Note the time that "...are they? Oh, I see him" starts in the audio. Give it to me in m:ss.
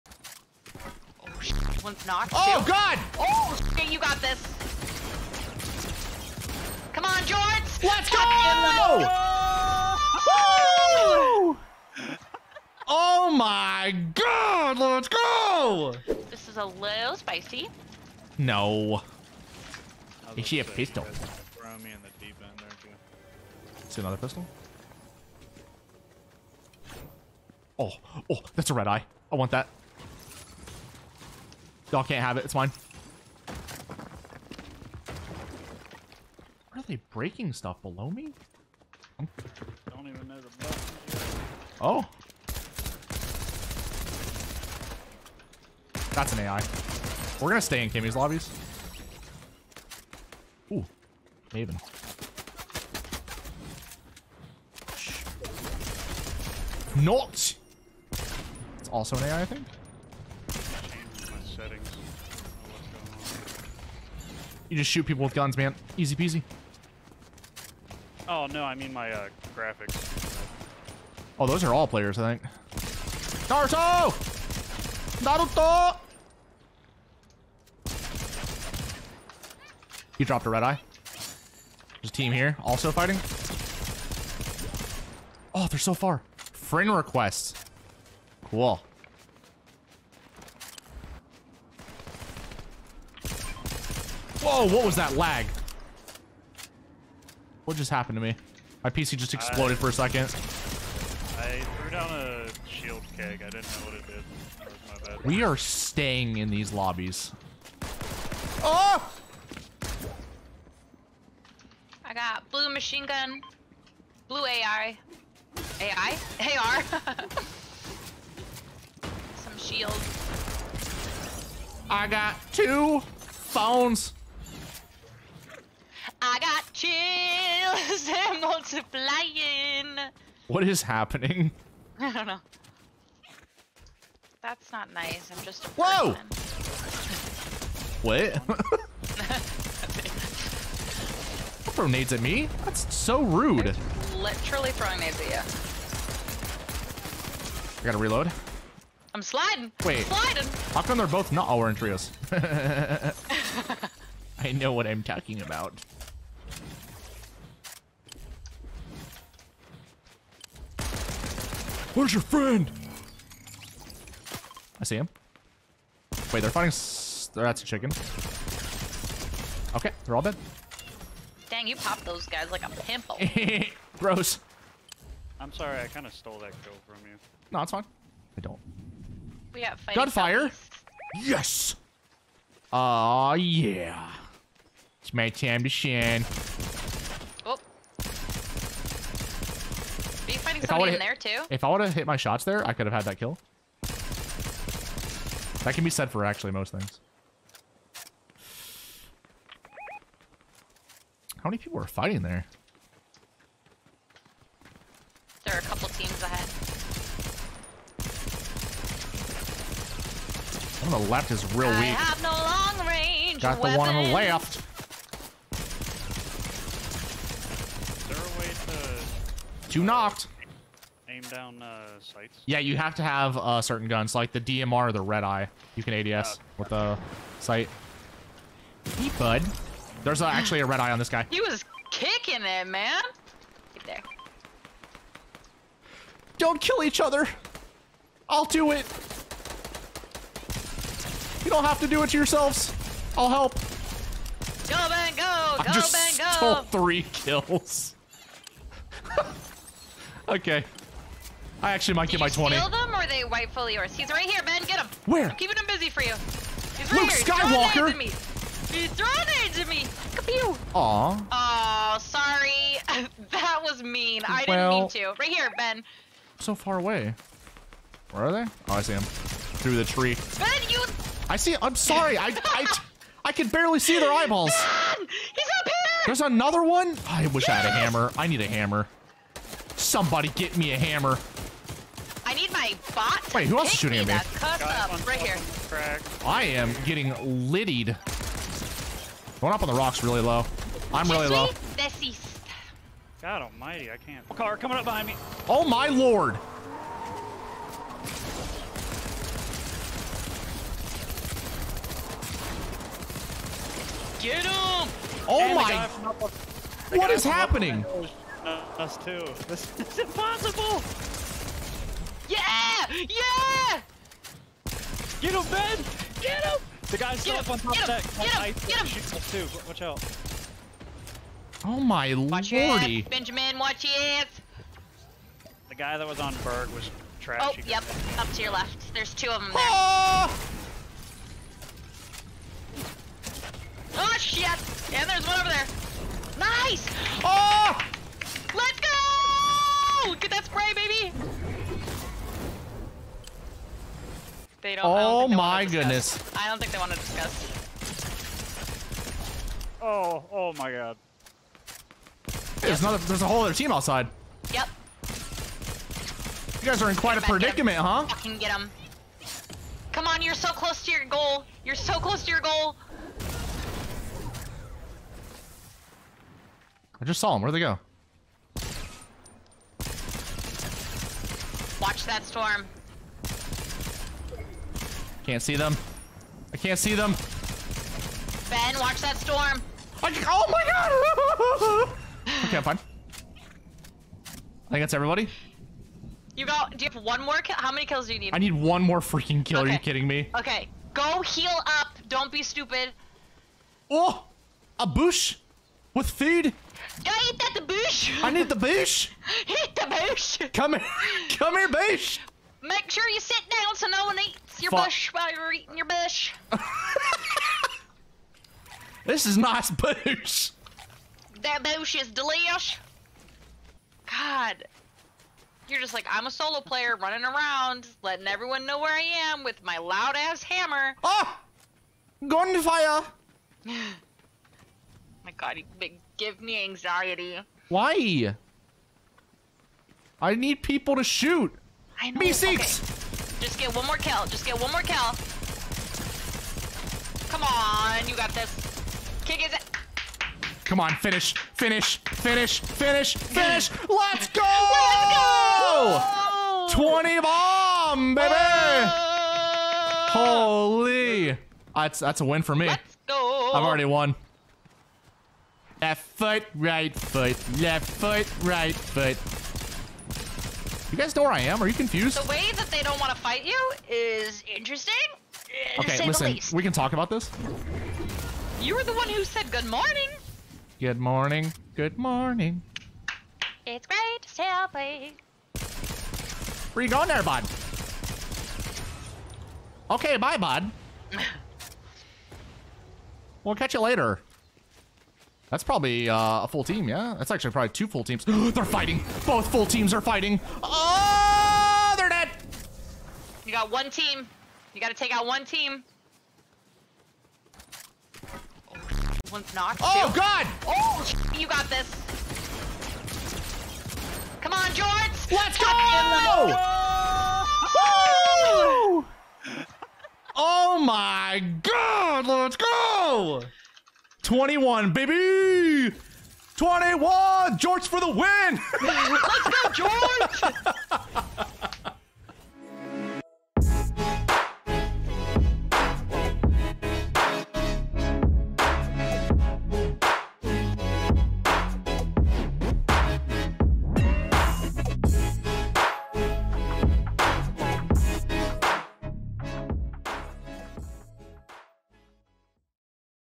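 4:28.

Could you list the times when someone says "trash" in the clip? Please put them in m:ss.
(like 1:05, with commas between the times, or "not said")
5:27.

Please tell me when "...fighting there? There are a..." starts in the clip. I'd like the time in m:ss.
3:21.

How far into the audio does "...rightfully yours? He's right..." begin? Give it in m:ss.
4:13.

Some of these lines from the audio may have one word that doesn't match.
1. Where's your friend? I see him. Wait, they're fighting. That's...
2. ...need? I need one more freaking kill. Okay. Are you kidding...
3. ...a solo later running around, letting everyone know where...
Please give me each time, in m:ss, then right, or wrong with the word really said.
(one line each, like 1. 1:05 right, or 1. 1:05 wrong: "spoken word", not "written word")
1. 2:41 right
2. 6:28 right
3. 6:56 wrong: "player", not "later".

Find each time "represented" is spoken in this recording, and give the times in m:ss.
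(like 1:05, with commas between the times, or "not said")
not said.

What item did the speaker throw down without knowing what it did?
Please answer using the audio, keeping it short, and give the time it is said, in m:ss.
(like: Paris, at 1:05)
Shield keg, at 1:42.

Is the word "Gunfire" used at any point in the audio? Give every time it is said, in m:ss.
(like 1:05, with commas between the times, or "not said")
3:00, 7:02.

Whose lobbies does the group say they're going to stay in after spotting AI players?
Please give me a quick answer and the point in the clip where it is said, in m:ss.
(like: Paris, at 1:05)
Kimmy's, at 0:47.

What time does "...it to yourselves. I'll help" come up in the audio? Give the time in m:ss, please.
4:02.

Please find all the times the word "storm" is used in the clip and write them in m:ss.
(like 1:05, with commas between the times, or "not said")
6:12, 6:19.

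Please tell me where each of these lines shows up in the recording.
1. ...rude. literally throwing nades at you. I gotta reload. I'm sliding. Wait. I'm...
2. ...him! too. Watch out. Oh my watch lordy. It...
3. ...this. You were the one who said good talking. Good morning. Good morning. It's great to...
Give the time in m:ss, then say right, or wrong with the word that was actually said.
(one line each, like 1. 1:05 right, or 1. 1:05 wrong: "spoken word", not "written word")
1. 2:23 right
2. 5:19 right
3. 7:47 wrong: "morning", not "talking".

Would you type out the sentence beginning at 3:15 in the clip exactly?
That can be said for actually most things.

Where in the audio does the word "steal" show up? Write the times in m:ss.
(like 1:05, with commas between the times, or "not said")
4:12.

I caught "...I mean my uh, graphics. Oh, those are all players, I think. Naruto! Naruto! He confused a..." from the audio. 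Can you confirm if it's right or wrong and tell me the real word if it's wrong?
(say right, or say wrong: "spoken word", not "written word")
wrong: "dropped", not "confused".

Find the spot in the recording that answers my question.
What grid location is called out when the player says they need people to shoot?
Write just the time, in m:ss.
7:12.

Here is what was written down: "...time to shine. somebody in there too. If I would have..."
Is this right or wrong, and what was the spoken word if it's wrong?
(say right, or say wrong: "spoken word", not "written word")
right.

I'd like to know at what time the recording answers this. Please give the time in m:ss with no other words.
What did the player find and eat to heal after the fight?
6:34.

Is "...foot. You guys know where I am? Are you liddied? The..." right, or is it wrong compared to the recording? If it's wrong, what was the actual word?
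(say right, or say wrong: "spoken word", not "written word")
wrong: "confused", not "liddied".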